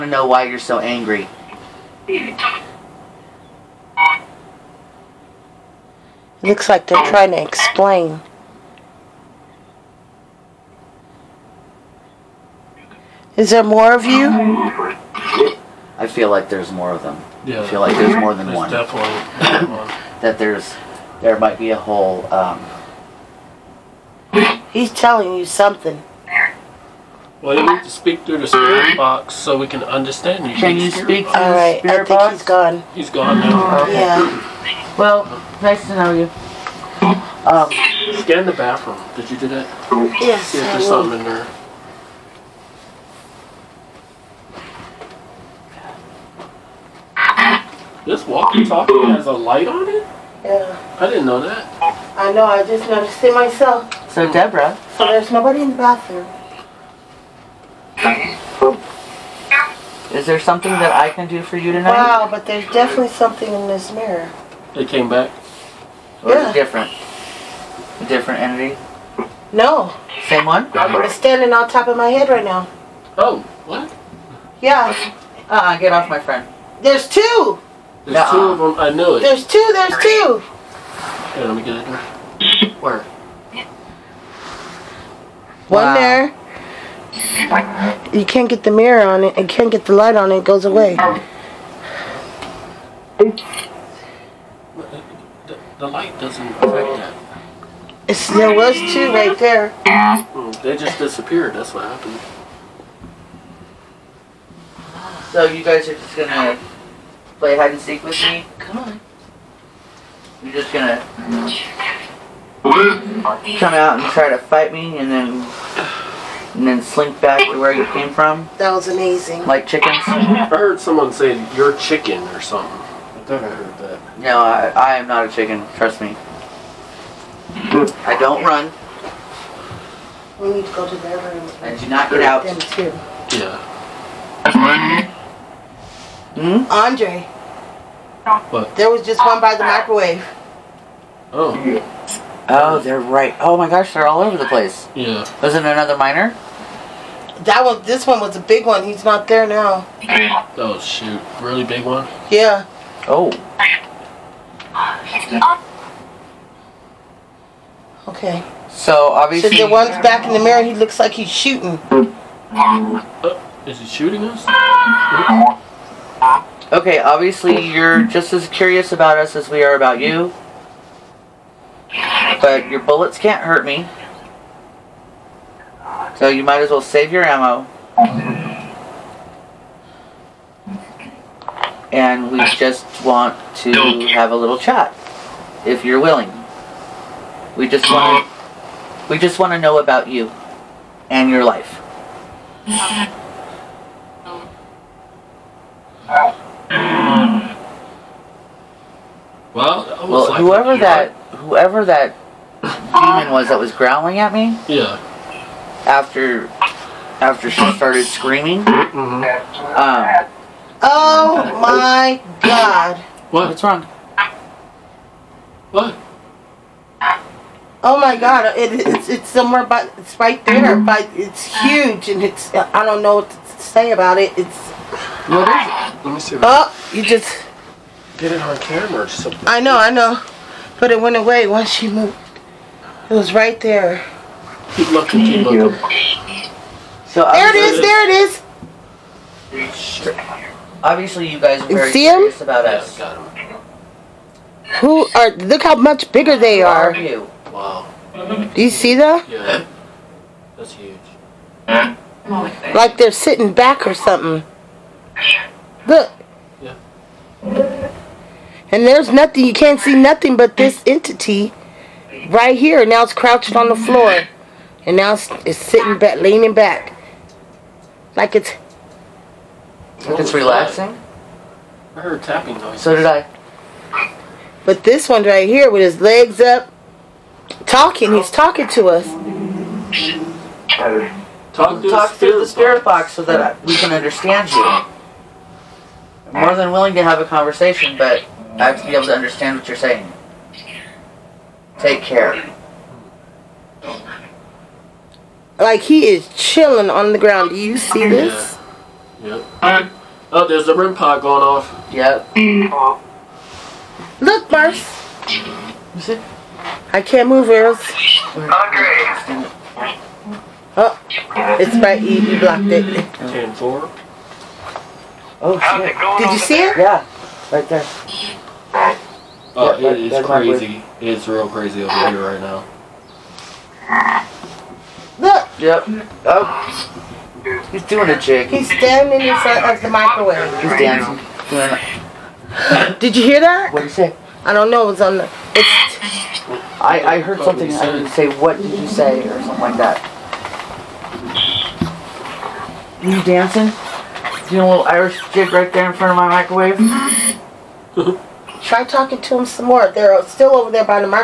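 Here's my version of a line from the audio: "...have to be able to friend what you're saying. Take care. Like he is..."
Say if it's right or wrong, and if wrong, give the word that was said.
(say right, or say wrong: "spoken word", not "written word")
wrong: "understand", not "friend".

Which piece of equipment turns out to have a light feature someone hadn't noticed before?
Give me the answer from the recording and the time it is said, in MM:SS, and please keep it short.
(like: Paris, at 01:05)
walkie-talkie, at 00:48.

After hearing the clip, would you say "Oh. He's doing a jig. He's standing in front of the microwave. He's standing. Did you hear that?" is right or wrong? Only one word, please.
wrong.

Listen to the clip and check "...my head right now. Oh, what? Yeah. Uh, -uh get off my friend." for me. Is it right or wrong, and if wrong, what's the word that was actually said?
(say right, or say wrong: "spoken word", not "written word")
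right.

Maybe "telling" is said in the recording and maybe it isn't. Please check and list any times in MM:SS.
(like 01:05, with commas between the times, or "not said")
00:24.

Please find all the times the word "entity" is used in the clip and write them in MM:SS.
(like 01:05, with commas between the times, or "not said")
01:08, 04:20.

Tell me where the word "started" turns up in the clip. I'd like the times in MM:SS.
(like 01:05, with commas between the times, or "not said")
03:27.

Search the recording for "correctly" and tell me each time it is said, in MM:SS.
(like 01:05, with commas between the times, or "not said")
not said.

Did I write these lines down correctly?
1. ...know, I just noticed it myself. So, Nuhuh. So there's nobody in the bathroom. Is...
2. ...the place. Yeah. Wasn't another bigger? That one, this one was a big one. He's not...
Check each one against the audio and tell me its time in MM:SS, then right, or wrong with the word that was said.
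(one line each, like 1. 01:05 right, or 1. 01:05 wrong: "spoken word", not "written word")
1. 00:52 wrong: "Deborah", not "Nuhuh"
2. 02:24 wrong: "miner", not "bigger".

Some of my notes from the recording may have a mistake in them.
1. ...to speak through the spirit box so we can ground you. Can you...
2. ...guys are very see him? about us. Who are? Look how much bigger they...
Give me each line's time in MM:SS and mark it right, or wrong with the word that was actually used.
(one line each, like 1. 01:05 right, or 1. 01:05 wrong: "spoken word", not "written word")
1. 00:27 wrong: "understand", not "ground"
2. 04:01 right.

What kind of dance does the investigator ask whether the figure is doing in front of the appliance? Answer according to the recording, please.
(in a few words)
Irish jig.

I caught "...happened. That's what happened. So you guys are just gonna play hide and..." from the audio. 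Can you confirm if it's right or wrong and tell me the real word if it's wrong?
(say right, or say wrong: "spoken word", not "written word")
wrong: "disappeared", not "happened".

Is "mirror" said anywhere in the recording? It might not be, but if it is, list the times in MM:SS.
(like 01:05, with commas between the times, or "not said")
01:03, 01:28, 02:40.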